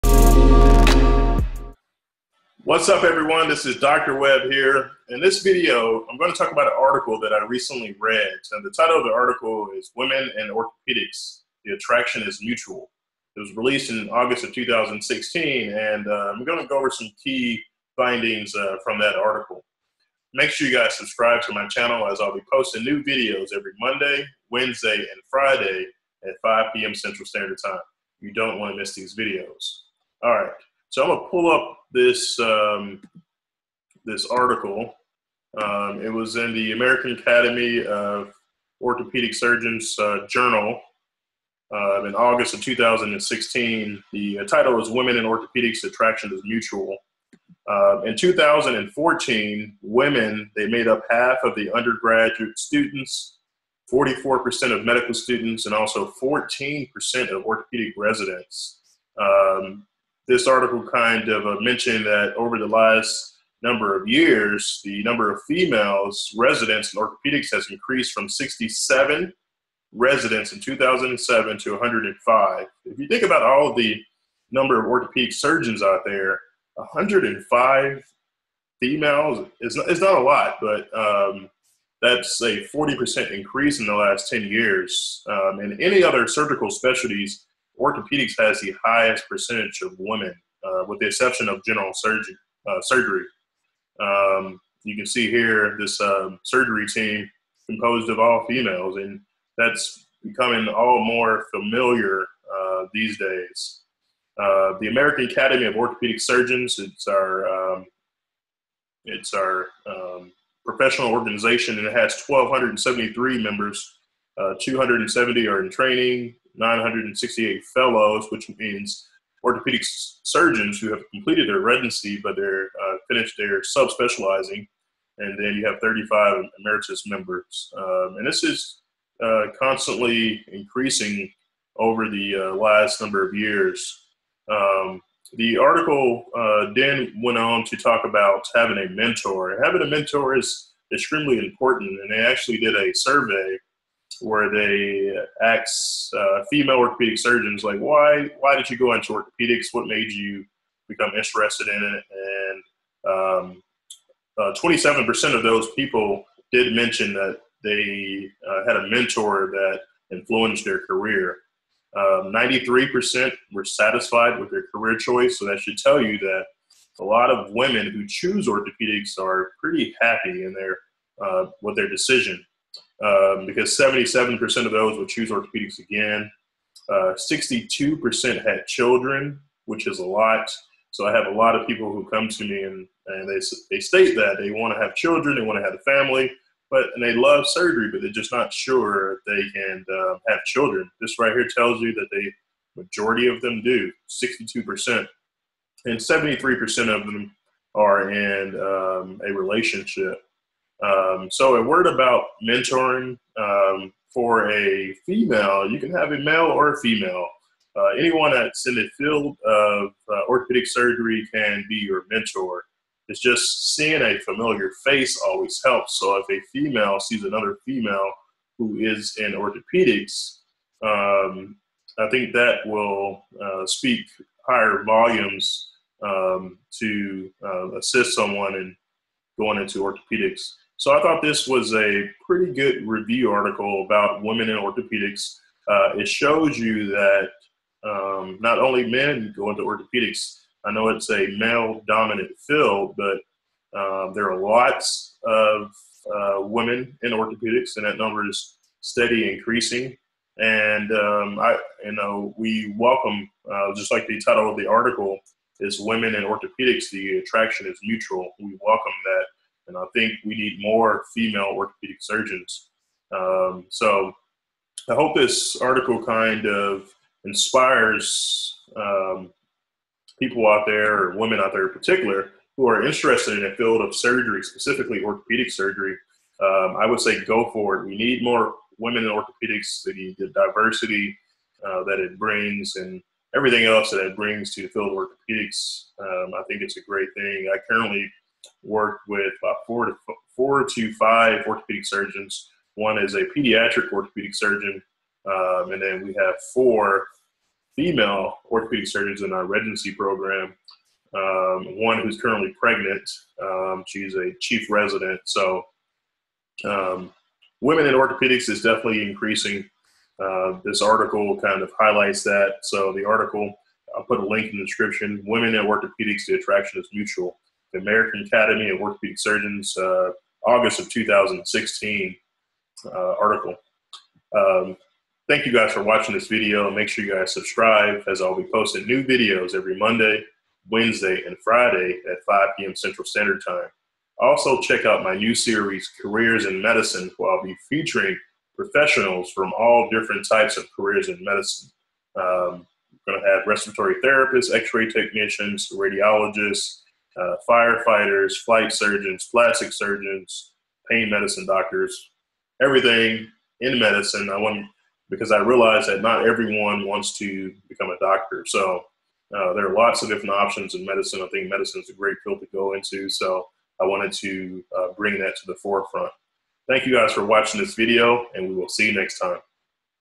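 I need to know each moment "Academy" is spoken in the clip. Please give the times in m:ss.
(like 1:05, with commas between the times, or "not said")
0:37, 1:45, 5:18.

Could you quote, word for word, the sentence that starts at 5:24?
Um, thank you guys for watching this video.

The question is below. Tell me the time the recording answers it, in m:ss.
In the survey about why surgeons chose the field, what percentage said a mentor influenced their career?
2:34.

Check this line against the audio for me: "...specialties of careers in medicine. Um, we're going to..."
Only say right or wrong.
wrong.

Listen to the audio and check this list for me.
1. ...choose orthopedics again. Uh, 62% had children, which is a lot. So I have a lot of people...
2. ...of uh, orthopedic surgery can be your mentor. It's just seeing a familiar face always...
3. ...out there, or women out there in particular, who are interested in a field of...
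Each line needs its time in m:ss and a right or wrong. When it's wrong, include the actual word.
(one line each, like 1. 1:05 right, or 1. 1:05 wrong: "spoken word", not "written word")
1. 2:55 right
2. 3:29 right
3. 4:30 right.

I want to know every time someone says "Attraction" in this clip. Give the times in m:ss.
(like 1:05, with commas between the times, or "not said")
0:11, 0:45, 4:17, 5:16.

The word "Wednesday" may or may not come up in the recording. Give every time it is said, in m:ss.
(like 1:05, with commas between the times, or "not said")
0:24, 5:30.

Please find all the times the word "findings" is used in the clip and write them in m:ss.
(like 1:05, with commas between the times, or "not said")
0:17.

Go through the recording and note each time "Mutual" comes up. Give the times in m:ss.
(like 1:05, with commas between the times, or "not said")
0:12, 0:46, 4:17, 5:16.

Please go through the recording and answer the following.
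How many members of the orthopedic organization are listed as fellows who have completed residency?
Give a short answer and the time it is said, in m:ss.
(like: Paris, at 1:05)
968, at 1:56.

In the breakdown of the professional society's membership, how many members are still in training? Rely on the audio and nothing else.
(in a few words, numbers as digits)
270.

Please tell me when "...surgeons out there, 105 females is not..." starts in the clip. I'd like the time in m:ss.
1:15.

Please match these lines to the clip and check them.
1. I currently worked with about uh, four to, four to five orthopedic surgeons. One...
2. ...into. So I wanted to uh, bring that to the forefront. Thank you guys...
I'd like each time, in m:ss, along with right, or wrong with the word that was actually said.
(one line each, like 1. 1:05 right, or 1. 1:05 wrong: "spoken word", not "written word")
1. 4:47 right
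2. 6:02 right.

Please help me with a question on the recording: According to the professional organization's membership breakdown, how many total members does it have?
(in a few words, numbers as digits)
1,273.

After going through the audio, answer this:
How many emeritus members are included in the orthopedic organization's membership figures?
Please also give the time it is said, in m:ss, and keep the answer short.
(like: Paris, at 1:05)
35, at 2:05.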